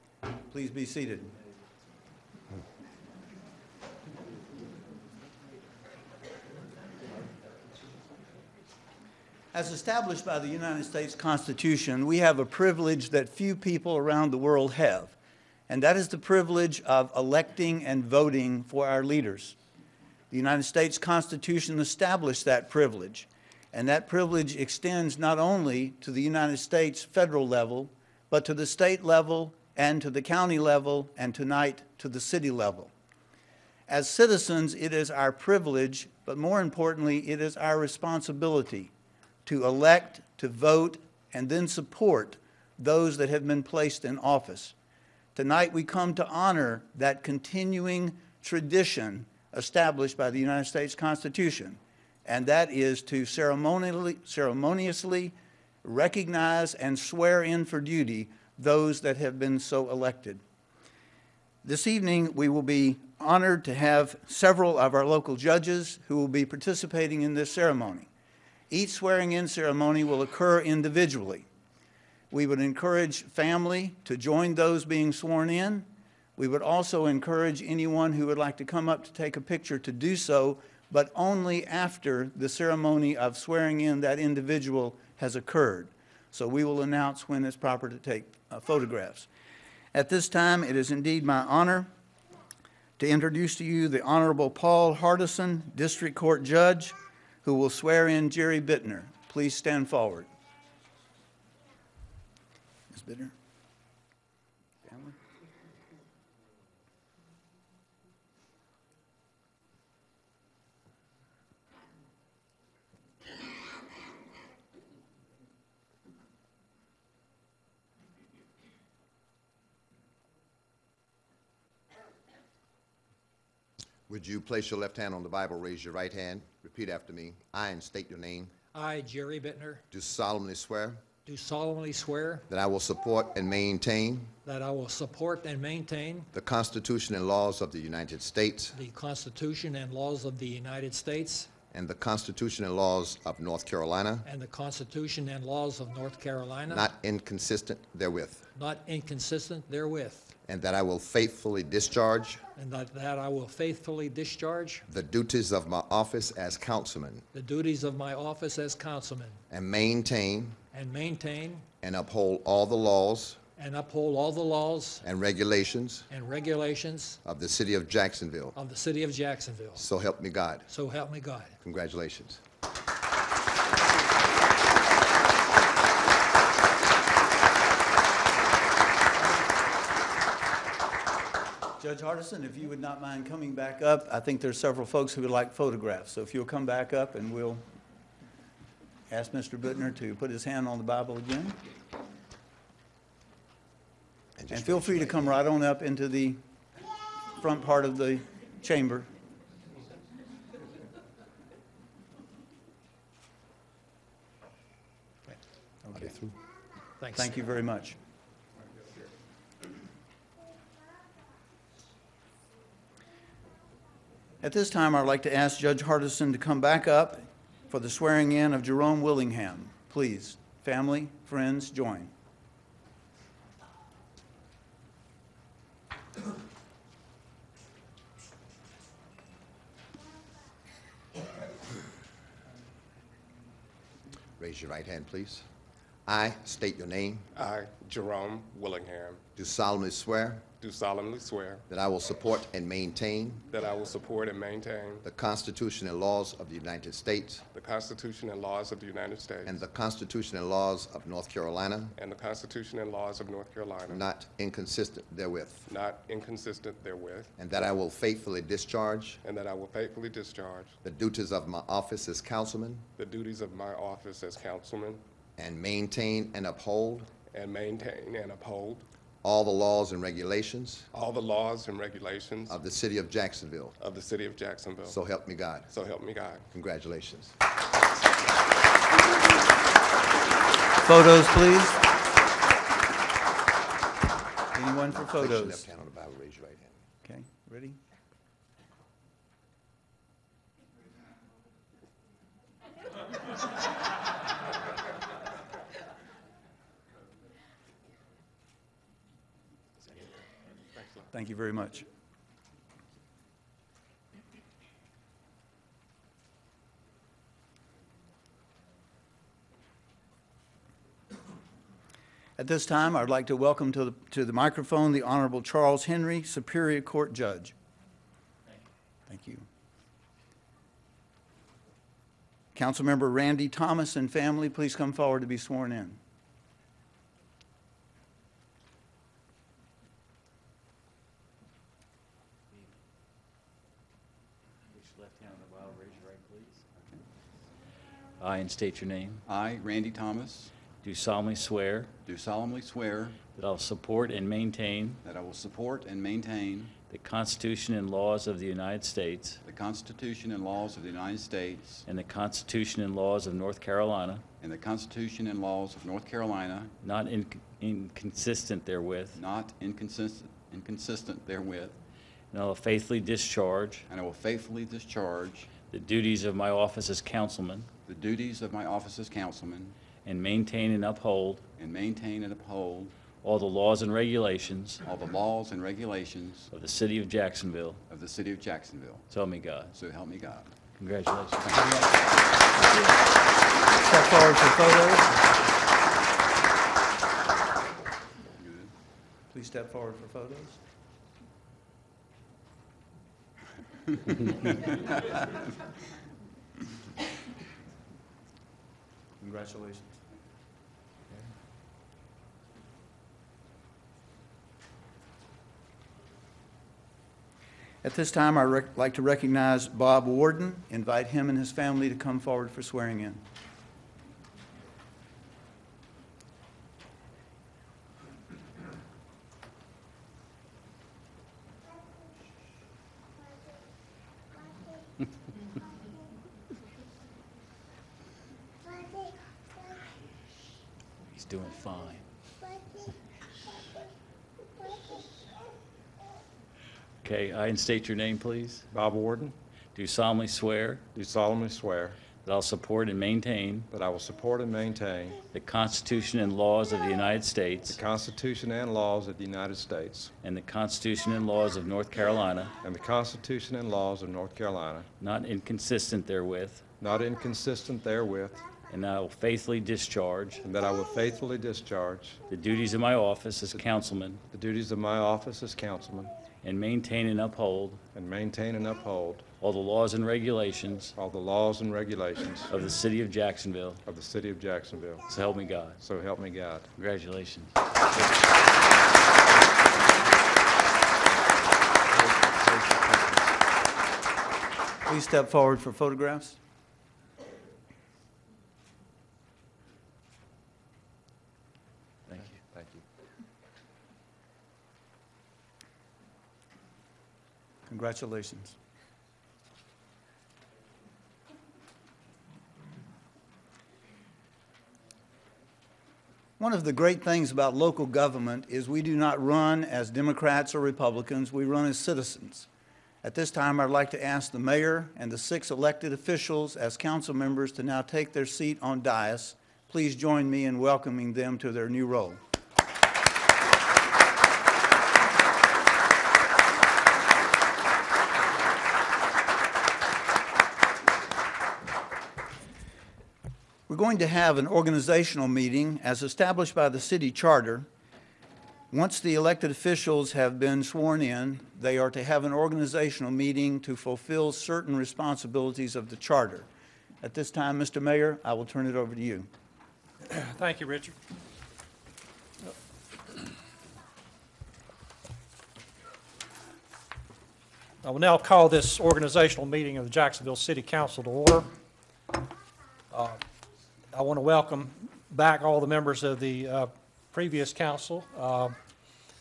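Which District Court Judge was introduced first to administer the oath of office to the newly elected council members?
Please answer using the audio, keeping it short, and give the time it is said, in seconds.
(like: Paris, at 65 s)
Paul Hardison, at 94 s.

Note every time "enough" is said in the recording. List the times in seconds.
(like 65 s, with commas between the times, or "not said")
not said.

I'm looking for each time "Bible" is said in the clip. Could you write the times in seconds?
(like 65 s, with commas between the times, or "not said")
125 s, 190 s, 285 s.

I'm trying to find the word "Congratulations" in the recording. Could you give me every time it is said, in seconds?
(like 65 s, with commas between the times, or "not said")
171 s, 276 s, 380 s, 399 s, 476 s, 497 s.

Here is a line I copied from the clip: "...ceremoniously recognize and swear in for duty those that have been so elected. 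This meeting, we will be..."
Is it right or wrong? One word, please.
wrong.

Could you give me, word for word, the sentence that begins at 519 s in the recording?
Please join me in welcoming them to their new role.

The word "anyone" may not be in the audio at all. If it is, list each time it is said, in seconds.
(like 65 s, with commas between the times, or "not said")
77 s, 284 s.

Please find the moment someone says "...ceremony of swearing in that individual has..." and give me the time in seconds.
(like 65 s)
82 s.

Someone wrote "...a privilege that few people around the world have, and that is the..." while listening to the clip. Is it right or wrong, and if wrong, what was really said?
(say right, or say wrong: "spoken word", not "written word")
right.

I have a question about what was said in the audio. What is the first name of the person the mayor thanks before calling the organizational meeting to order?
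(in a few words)
Richard.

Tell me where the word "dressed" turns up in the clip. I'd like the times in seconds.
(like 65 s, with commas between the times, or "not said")
not said.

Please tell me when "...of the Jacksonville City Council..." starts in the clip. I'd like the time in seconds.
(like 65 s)
559 s.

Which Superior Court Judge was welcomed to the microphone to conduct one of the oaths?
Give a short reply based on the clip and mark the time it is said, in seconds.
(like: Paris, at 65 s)
Charles Henry, at 315 s.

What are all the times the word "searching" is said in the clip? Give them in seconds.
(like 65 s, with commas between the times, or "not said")
not said.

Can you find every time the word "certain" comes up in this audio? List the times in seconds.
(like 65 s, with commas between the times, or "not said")
544 s.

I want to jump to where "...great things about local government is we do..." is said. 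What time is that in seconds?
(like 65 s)
506 s.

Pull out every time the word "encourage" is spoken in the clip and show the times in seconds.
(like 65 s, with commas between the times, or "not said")
72 s, 77 s.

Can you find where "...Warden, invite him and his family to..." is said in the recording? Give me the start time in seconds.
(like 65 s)
410 s.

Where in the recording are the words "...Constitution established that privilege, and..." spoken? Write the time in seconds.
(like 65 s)
20 s.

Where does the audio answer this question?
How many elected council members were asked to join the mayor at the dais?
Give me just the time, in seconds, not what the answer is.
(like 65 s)
515 s.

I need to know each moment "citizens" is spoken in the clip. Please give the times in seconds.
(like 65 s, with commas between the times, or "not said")
34 s, 511 s.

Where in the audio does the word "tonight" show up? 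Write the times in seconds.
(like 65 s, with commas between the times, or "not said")
31 s, 45 s.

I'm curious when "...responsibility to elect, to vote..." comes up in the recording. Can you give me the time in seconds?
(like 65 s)
37 s.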